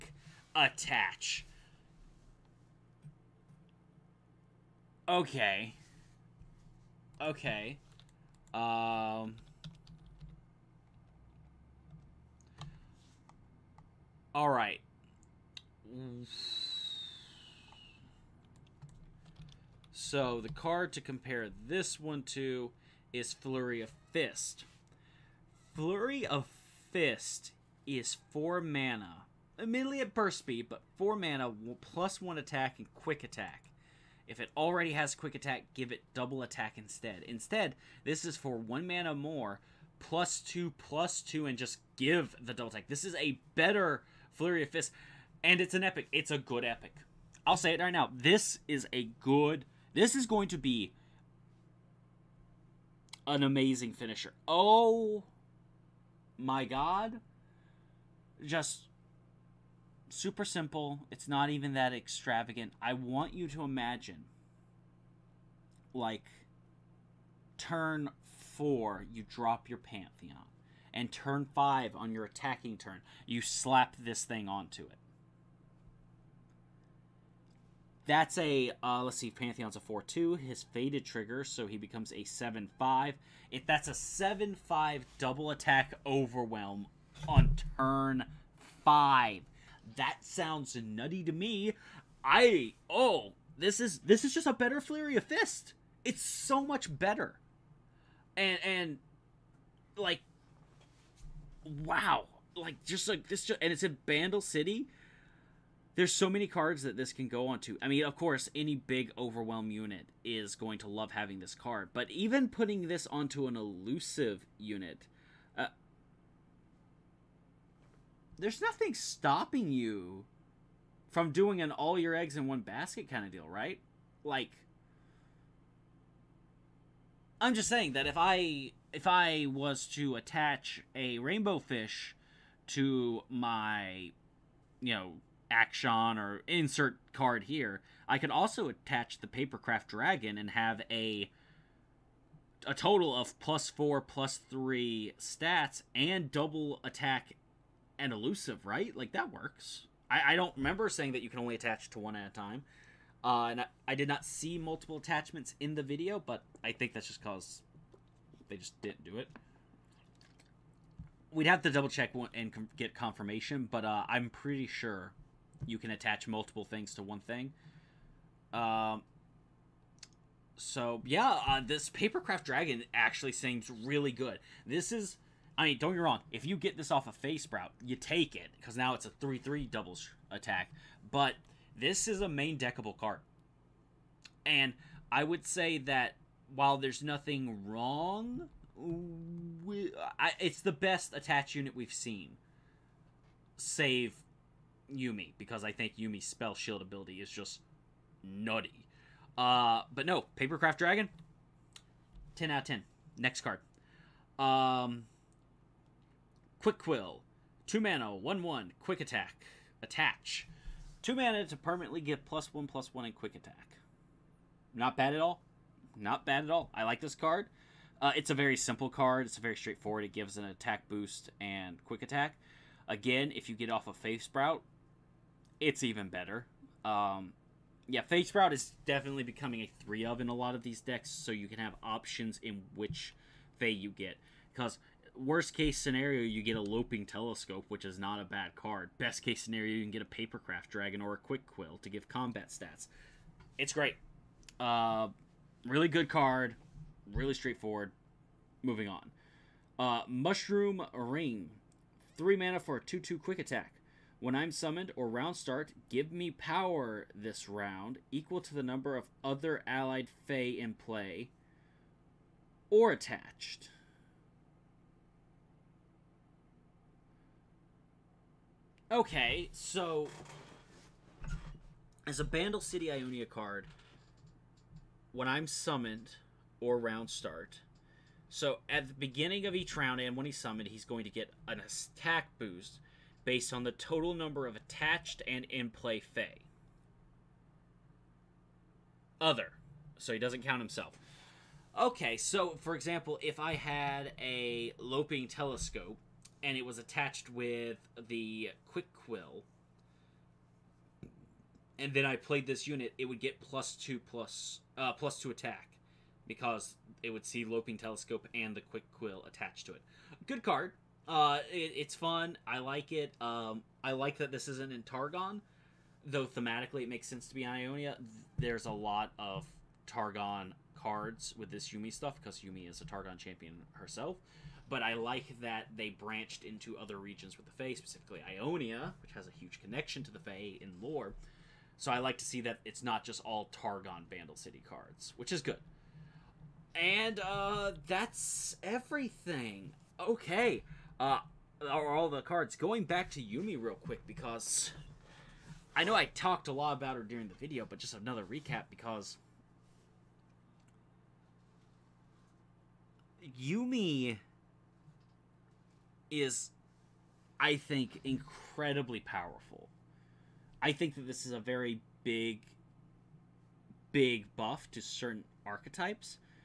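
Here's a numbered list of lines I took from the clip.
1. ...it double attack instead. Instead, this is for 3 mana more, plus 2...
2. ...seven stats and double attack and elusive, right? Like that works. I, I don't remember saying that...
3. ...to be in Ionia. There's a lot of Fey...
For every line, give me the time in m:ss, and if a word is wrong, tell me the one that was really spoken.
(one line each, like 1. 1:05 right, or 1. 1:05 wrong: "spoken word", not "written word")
1. 0:35 wrong: "1", not "3"
2. 2:24 wrong: "three", not "seven"
3. 5:17 wrong: "Targon", not "Fey".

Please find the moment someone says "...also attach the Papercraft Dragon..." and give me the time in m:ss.
2:18.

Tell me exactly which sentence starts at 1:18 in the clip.
That's a, uh, let's see, Pantheon's a 4 2.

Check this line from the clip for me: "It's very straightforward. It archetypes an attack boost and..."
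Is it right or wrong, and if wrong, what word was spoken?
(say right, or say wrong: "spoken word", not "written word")
wrong: "gives", not "archetypes".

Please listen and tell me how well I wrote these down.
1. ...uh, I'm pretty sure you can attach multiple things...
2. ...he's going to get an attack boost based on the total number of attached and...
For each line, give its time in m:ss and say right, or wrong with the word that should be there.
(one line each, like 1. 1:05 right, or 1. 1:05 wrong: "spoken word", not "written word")
1. 2:43 right
2. 4:40 right.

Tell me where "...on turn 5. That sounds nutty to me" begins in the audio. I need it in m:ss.
1:27.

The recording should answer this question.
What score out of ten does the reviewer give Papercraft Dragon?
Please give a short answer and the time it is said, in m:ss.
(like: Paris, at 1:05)
10, at 3:22.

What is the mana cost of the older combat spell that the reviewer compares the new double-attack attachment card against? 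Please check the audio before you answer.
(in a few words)
4.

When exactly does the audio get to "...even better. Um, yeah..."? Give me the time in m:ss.
3:45.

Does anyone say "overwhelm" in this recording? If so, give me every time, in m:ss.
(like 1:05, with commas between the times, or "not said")
1:26, 1:49.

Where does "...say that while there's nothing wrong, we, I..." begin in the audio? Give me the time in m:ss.
3:05.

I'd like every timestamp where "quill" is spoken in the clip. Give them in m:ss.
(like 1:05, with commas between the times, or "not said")
3:26, 4:01, 4:58, 5:08.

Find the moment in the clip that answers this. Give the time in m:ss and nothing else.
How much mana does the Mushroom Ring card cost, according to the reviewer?
4:12.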